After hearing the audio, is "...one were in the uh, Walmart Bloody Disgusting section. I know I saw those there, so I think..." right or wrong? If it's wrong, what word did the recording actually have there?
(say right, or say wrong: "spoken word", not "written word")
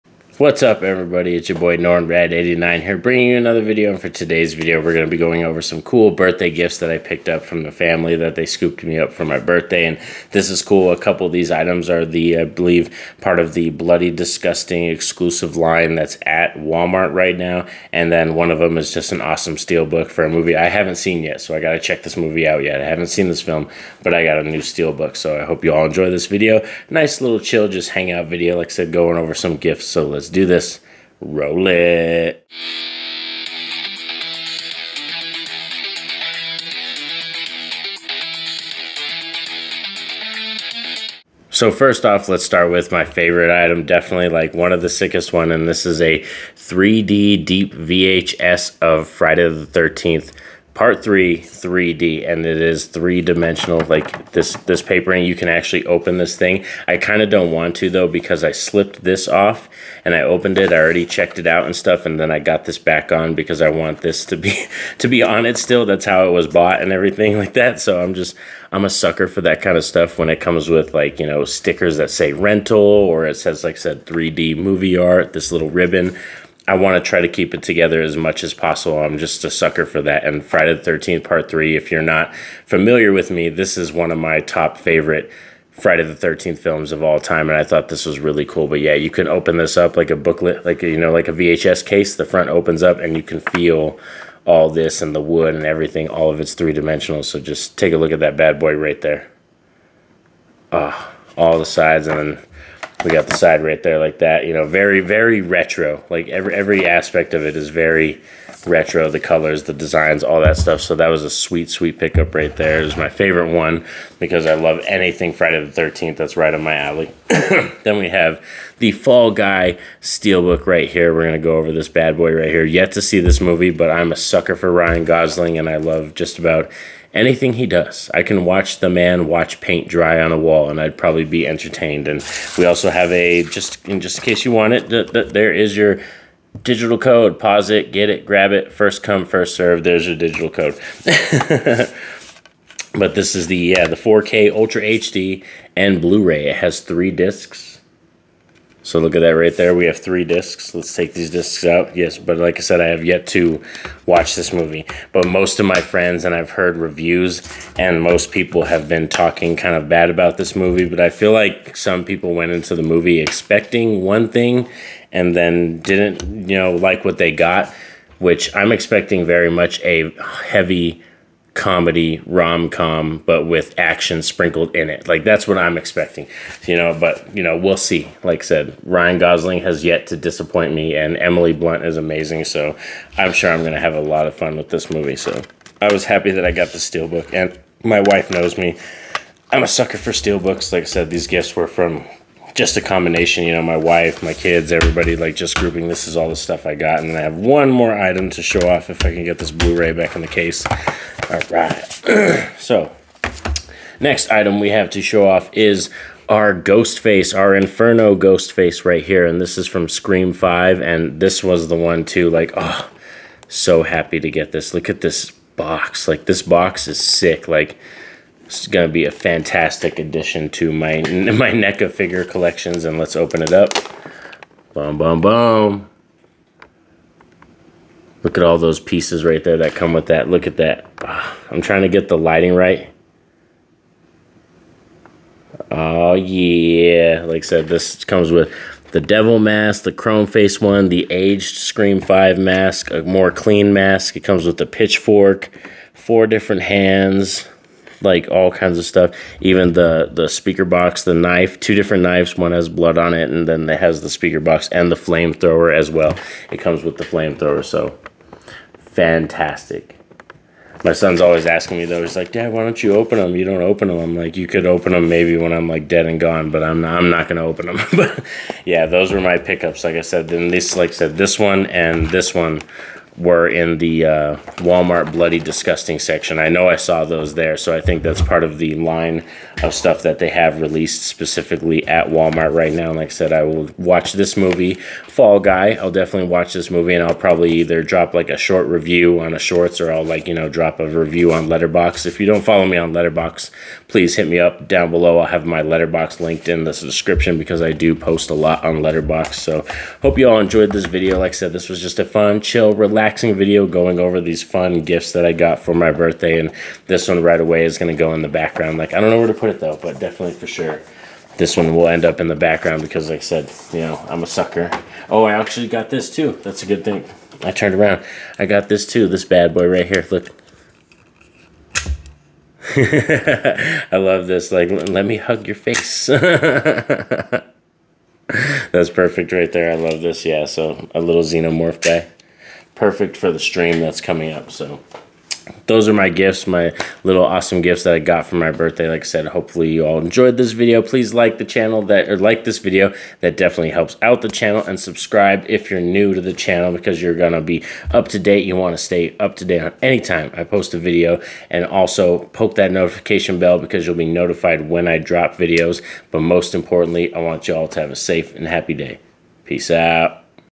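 right.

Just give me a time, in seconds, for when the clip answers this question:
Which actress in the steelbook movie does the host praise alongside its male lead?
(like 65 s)
181 s.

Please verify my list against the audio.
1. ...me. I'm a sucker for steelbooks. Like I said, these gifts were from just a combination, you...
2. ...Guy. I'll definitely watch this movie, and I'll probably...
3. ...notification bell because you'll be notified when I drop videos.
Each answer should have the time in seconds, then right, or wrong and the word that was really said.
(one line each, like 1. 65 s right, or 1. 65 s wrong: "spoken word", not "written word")
1. 188 s right
2. 285 s right
3. 352 s right.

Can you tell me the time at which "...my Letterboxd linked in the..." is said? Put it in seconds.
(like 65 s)
295 s.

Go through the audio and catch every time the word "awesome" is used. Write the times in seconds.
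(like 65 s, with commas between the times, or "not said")
19 s, 337 s.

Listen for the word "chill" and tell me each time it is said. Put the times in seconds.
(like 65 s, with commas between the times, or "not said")
27 s, 302 s.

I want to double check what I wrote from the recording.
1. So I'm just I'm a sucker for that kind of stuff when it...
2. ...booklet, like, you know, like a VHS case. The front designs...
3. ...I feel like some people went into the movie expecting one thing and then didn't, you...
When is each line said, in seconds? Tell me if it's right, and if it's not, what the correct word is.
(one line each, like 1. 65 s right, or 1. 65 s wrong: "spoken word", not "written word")
1. 67 s right
2. 90 s wrong: "opens", not "designs"
3. 160 s right.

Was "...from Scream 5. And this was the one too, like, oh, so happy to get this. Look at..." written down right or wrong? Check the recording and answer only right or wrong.
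right.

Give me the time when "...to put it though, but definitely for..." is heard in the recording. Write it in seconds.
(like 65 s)
309 s.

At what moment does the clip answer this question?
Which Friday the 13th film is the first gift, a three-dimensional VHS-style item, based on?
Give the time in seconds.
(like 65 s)
50 s.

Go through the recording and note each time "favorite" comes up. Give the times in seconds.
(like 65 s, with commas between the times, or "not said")
43 s, 84 s, 113 s.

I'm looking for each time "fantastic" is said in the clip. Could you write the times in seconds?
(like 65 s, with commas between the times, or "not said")
219 s, 258 s.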